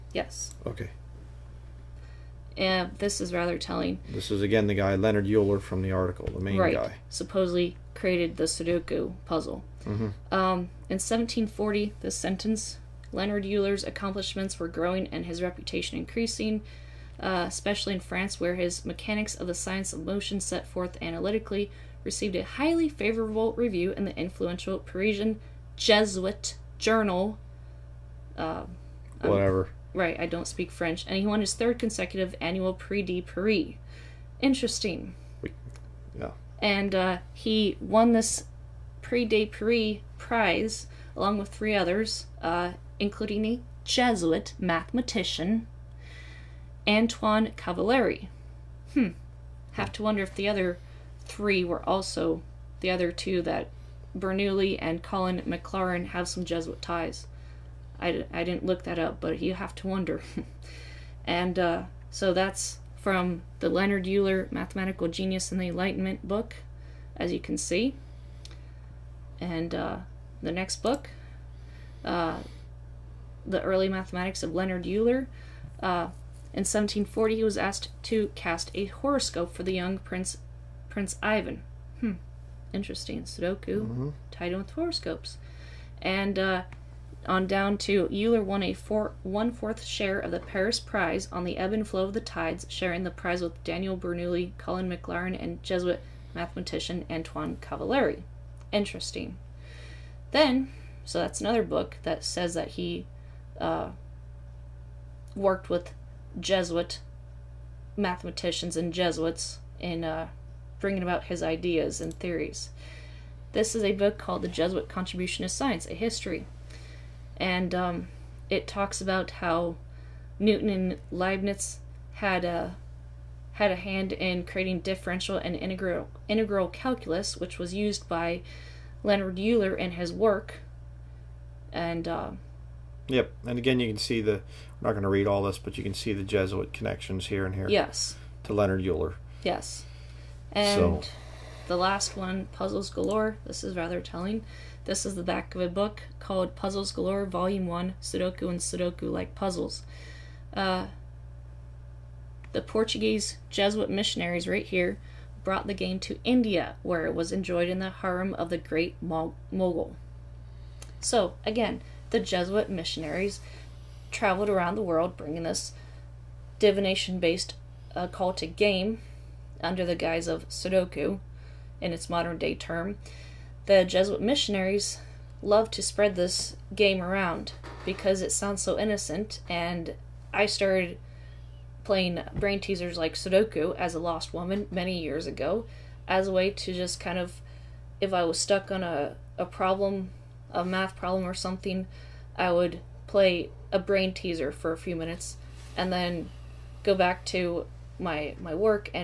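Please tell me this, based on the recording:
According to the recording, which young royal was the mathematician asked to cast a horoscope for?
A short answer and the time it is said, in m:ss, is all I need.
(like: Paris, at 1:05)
Prince Ivan, at 1:20.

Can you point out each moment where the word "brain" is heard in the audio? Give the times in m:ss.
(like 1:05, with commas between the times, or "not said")
3:02, 3:13.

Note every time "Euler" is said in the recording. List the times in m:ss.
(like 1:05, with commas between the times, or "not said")
0:05, 0:13, 1:04, 1:14, 1:28, 2:09, 2:18.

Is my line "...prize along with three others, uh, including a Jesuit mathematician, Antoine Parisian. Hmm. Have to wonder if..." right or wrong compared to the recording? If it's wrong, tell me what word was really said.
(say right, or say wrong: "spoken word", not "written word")
wrong: "Cavalleri", not "Parisian".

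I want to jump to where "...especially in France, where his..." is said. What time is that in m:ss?
0:17.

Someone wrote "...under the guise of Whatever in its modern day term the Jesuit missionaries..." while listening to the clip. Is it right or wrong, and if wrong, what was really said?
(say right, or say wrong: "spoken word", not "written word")
wrong: "Sudoku", not "Whatever".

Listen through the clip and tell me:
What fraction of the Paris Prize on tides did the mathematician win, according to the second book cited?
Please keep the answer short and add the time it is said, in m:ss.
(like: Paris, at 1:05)
1/4, at 1:29.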